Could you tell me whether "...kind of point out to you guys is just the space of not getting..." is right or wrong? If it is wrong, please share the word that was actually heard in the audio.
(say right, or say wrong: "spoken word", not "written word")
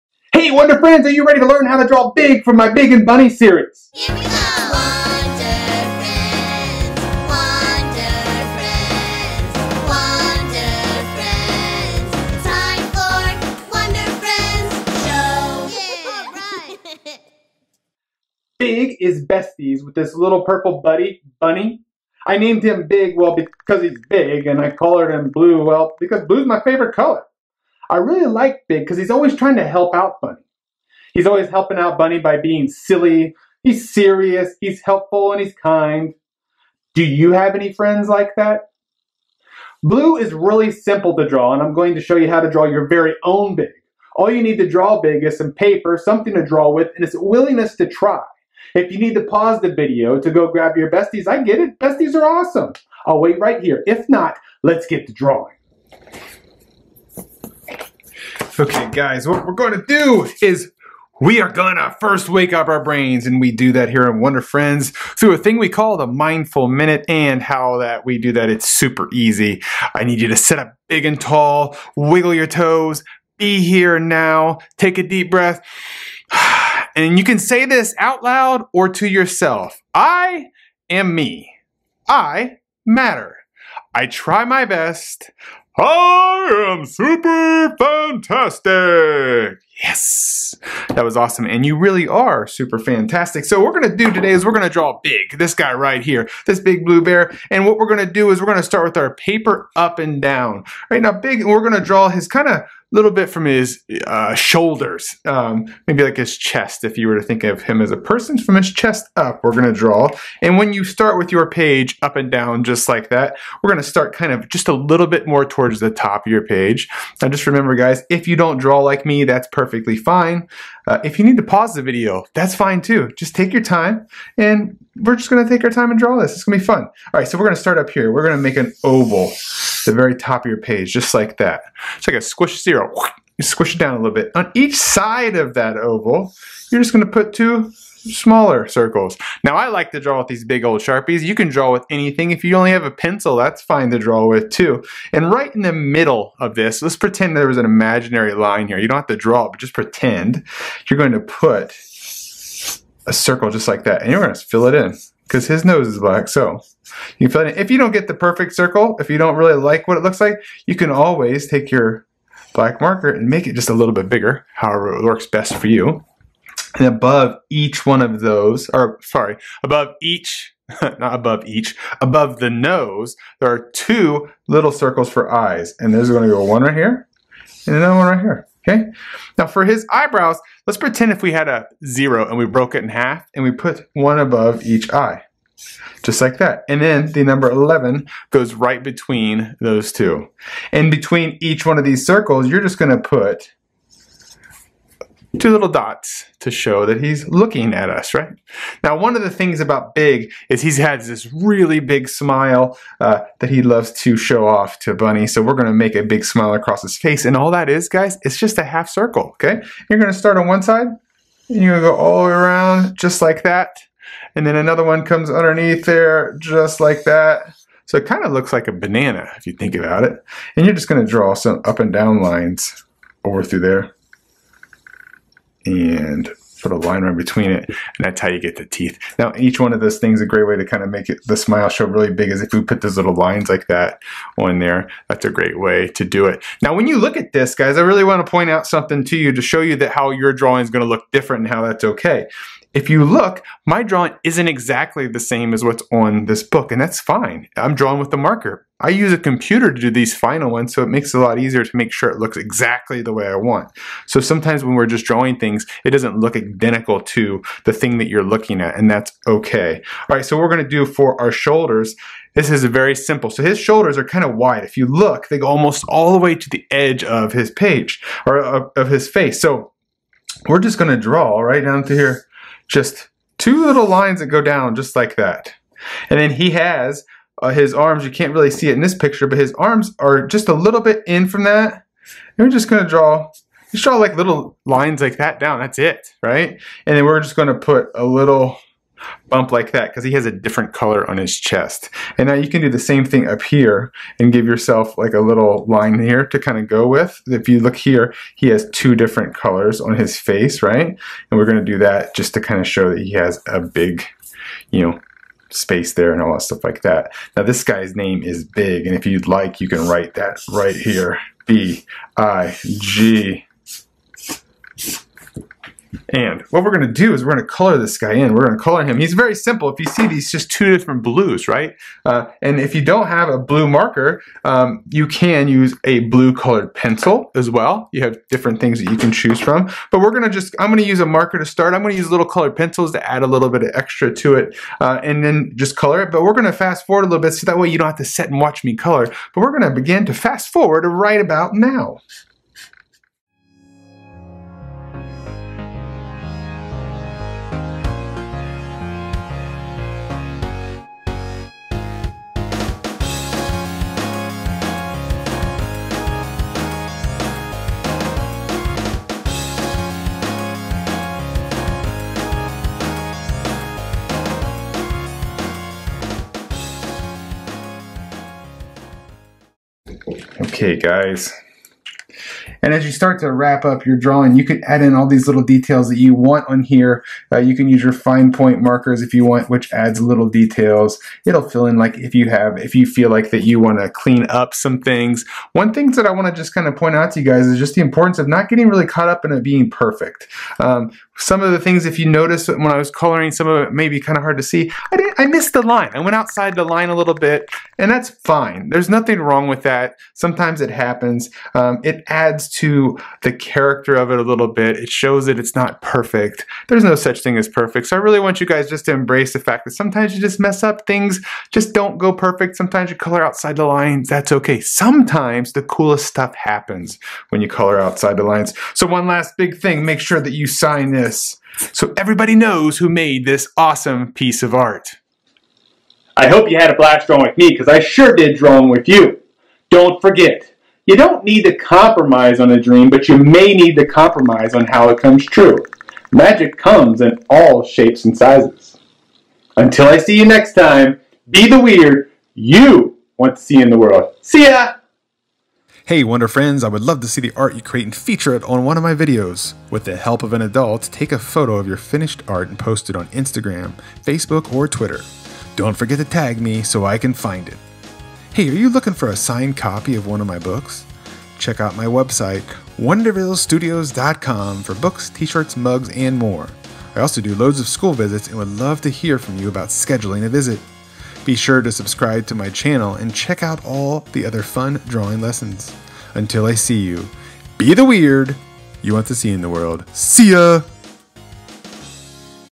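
wrong: "importance", not "space".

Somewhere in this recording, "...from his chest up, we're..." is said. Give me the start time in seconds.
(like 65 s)
108 s.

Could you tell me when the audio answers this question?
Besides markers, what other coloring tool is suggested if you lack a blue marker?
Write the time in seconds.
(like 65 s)
326 s.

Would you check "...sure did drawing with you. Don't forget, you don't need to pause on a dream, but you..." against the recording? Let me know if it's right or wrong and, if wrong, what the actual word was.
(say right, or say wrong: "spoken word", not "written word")
wrong: "compromise", not "pause".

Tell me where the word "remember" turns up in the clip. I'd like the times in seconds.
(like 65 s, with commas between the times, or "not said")
117 s.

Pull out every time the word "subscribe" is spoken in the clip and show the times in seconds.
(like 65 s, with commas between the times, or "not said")
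471 s.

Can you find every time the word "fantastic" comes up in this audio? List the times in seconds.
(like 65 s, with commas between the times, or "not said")
87 s, 92 s.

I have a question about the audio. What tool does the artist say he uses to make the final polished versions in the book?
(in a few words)
a computer.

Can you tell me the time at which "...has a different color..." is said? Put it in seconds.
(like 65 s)
290 s.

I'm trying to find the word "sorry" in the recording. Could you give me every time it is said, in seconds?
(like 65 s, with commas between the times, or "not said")
169 s.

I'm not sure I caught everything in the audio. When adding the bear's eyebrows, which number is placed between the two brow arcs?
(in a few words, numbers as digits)
11.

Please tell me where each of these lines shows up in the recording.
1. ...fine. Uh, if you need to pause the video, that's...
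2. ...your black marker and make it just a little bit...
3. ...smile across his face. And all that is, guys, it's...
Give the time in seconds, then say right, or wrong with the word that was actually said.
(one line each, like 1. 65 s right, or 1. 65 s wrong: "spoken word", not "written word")
1. 119 s right
2. 161 s right
3. 206 s right.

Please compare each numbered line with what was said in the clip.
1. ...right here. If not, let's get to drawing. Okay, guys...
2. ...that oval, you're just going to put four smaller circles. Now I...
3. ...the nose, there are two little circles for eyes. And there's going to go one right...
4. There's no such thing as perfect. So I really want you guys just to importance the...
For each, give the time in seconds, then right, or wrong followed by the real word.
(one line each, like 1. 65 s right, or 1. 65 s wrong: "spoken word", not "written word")
1. 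53 s right
2. 135 s wrong: "two", not "four"
3. 172 s right
4. 406 s wrong: "embrace", not "importance".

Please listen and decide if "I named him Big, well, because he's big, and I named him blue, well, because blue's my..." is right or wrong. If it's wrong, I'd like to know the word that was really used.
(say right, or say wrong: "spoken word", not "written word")
wrong: "colored", not "named".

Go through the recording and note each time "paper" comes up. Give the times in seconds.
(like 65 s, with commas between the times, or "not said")
45 s, 99 s.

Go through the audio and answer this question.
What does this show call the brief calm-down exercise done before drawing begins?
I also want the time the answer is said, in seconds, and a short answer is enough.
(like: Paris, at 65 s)
the mindful minute, at 66 s.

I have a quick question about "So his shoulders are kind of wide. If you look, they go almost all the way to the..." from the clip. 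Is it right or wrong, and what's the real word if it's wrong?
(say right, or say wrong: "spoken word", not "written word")
right.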